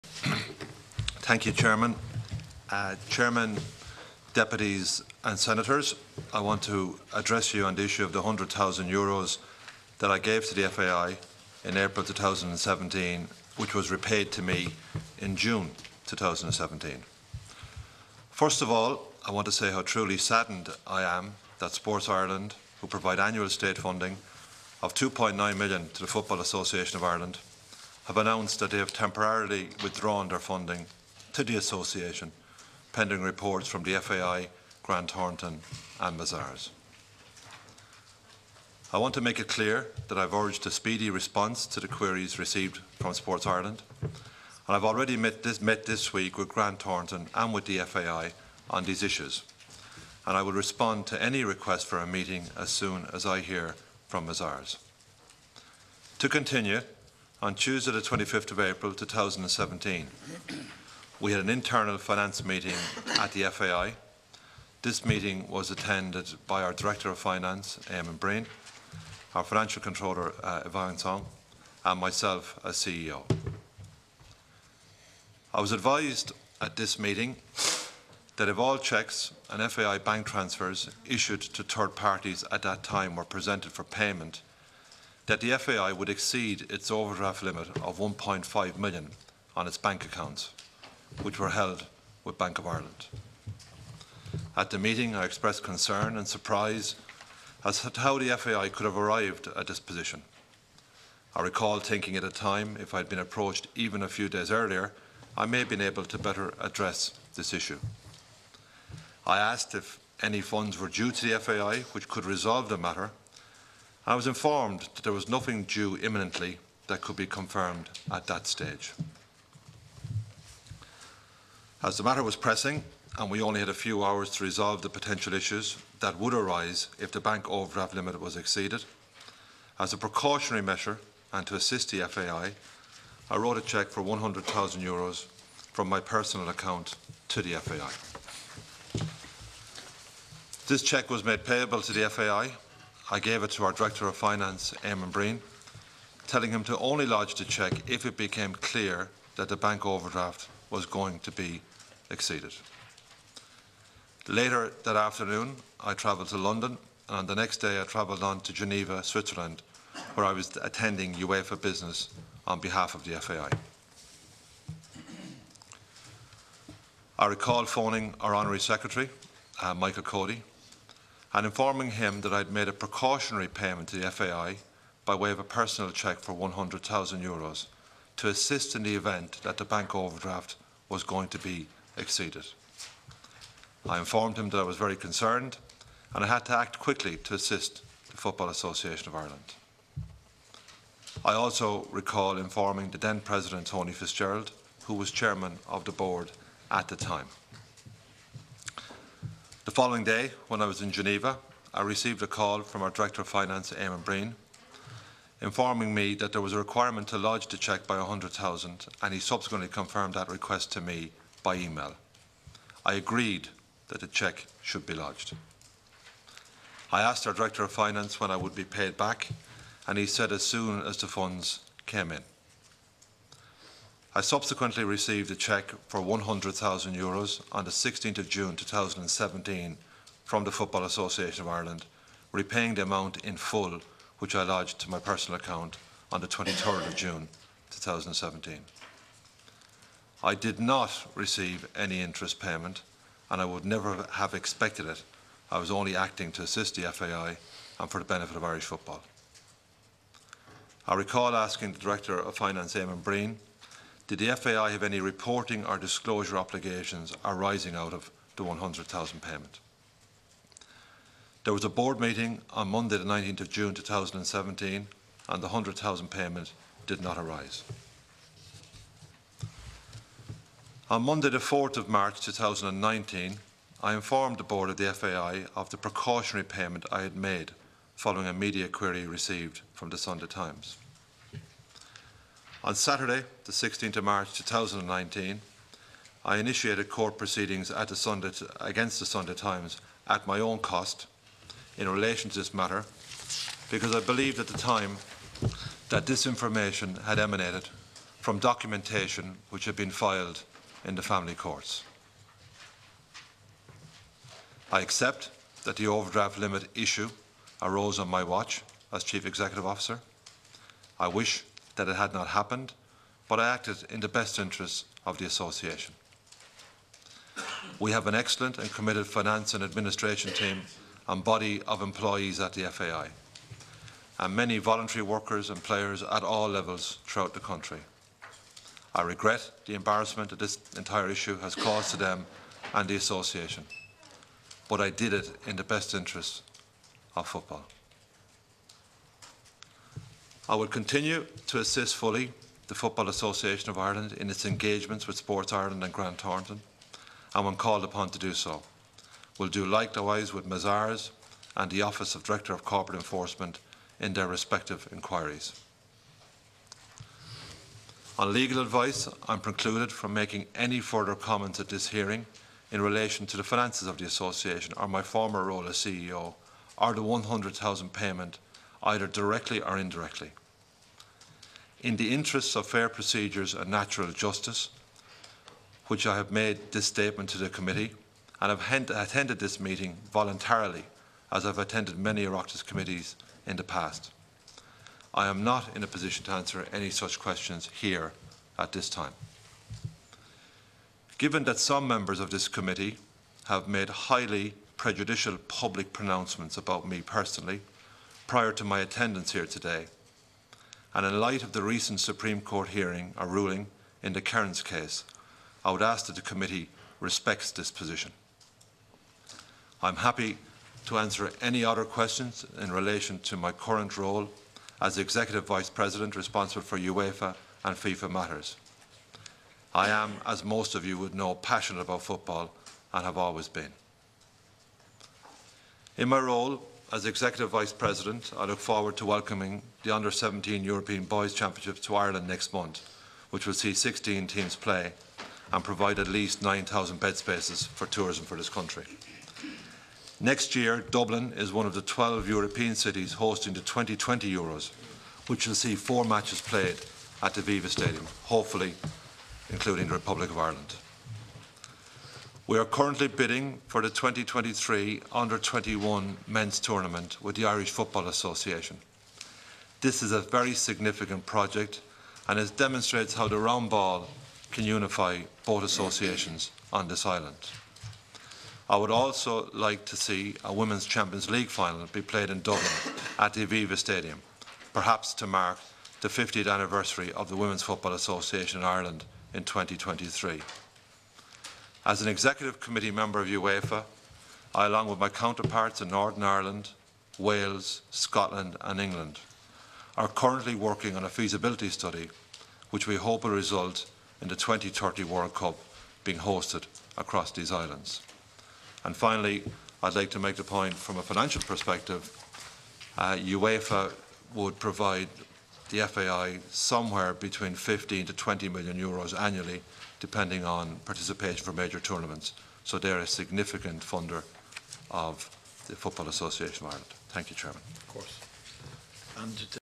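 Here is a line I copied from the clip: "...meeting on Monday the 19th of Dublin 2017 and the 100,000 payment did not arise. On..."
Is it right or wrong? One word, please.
wrong.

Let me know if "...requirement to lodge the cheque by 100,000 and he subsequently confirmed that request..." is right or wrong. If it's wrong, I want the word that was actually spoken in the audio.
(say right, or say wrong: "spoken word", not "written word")
right.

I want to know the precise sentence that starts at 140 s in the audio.
This cheque was made payable to the FAI.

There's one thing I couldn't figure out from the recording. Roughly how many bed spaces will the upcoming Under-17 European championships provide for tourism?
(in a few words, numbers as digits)
9,000.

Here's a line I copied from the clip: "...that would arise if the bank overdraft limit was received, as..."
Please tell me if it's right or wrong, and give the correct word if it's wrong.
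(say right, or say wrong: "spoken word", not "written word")
wrong: "exceeded", not "received".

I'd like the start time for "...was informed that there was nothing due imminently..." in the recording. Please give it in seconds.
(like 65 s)
114 s.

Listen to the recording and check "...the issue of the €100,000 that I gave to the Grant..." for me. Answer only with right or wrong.
wrong.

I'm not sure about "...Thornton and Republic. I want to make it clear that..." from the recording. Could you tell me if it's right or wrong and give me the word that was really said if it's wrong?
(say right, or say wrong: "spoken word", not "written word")
wrong: "Mazars", not "Republic".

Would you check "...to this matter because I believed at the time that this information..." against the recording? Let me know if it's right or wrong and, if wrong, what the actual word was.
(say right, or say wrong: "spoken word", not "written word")
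right.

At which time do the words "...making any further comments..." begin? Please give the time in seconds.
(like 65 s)
360 s.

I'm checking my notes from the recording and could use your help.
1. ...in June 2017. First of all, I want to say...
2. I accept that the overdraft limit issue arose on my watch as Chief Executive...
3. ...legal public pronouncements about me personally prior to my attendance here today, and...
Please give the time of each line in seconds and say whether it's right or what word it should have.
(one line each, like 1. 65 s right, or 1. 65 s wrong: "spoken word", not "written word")
1. 15 s right
2. 304 s right
3. 394 s wrong: "prejudicial", not "legal".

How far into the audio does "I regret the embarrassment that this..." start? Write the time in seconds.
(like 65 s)
328 s.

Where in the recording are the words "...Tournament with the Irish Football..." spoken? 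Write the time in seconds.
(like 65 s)
456 s.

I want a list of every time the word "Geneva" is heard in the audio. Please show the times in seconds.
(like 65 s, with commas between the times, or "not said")
158 s, 200 s.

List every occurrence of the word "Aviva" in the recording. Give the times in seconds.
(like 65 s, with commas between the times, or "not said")
447 s, 473 s.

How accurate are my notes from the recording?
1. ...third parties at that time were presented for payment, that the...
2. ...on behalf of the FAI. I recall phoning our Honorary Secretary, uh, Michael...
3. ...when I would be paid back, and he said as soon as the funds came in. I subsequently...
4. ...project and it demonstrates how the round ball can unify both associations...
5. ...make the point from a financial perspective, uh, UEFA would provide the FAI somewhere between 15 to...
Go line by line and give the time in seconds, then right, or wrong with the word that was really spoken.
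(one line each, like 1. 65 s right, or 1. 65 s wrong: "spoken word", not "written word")
1. 81 s right
2. 162 s right
3. 218 s right
4. 461 s right
5. 500 s right.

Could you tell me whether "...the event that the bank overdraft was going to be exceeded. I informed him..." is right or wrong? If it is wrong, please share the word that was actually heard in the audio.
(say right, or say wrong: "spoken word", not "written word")
right.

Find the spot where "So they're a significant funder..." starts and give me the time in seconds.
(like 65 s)
512 s.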